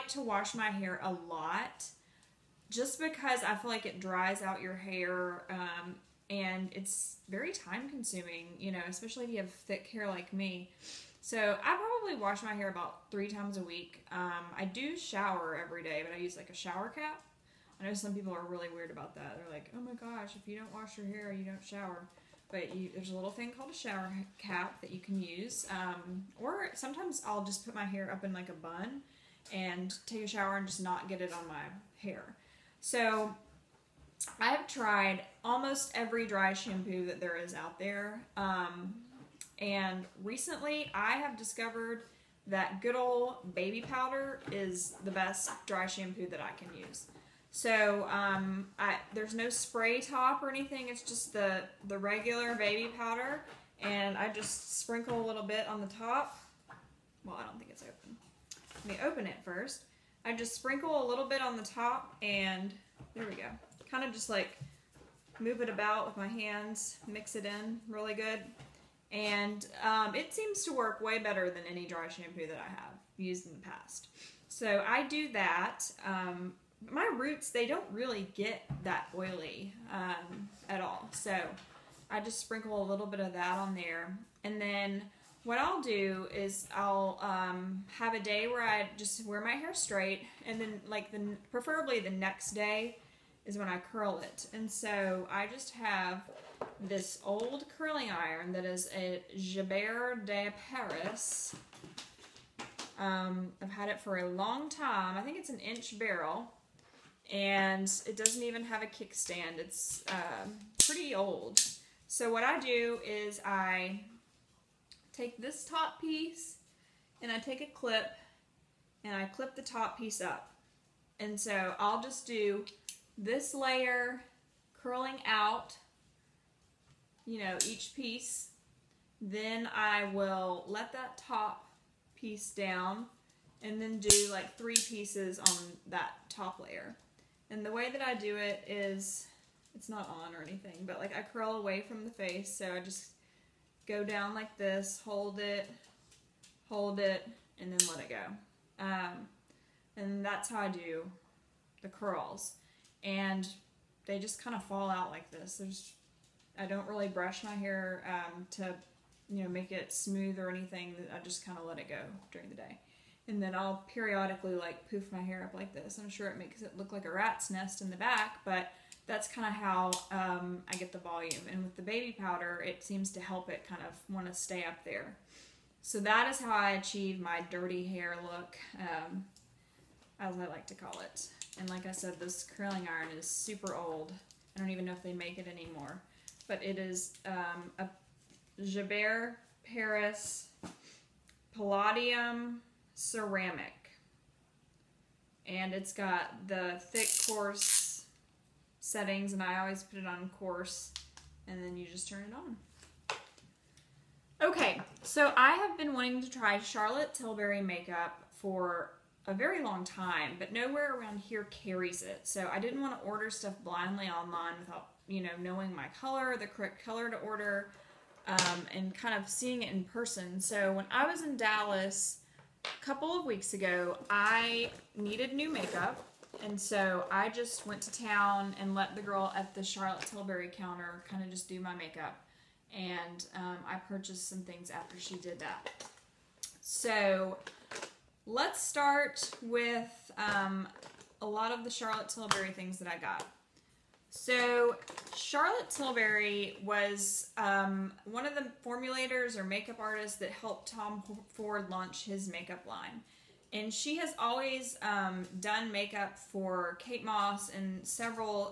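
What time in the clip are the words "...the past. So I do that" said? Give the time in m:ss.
1:13.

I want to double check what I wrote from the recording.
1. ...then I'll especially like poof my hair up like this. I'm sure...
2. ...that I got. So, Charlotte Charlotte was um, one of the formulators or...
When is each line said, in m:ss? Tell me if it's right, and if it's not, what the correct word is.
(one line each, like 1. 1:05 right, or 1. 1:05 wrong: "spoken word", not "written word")
1. 2:43 wrong: "periodically", not "especially"
2. 4:02 wrong: "Tilbury", not "Charlotte".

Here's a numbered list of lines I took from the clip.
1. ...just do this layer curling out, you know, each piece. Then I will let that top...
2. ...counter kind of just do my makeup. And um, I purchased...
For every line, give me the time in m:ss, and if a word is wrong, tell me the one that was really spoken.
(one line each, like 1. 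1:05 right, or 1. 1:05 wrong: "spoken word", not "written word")
1. 2:02 right
2. 3:50 right.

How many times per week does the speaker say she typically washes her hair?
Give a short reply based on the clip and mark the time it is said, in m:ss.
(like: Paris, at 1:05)
3, at 0:13.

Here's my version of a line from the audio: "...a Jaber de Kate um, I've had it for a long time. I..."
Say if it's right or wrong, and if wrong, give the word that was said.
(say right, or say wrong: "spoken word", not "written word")
wrong: "Paris", not "Kate".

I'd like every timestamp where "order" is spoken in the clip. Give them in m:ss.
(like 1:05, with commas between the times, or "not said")
3:33, 3:37.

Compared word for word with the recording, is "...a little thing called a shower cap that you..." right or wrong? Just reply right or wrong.
right.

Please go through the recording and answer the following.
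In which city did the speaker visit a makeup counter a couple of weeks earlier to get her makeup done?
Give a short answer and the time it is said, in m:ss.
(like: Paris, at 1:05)
Dallas, at 3:41.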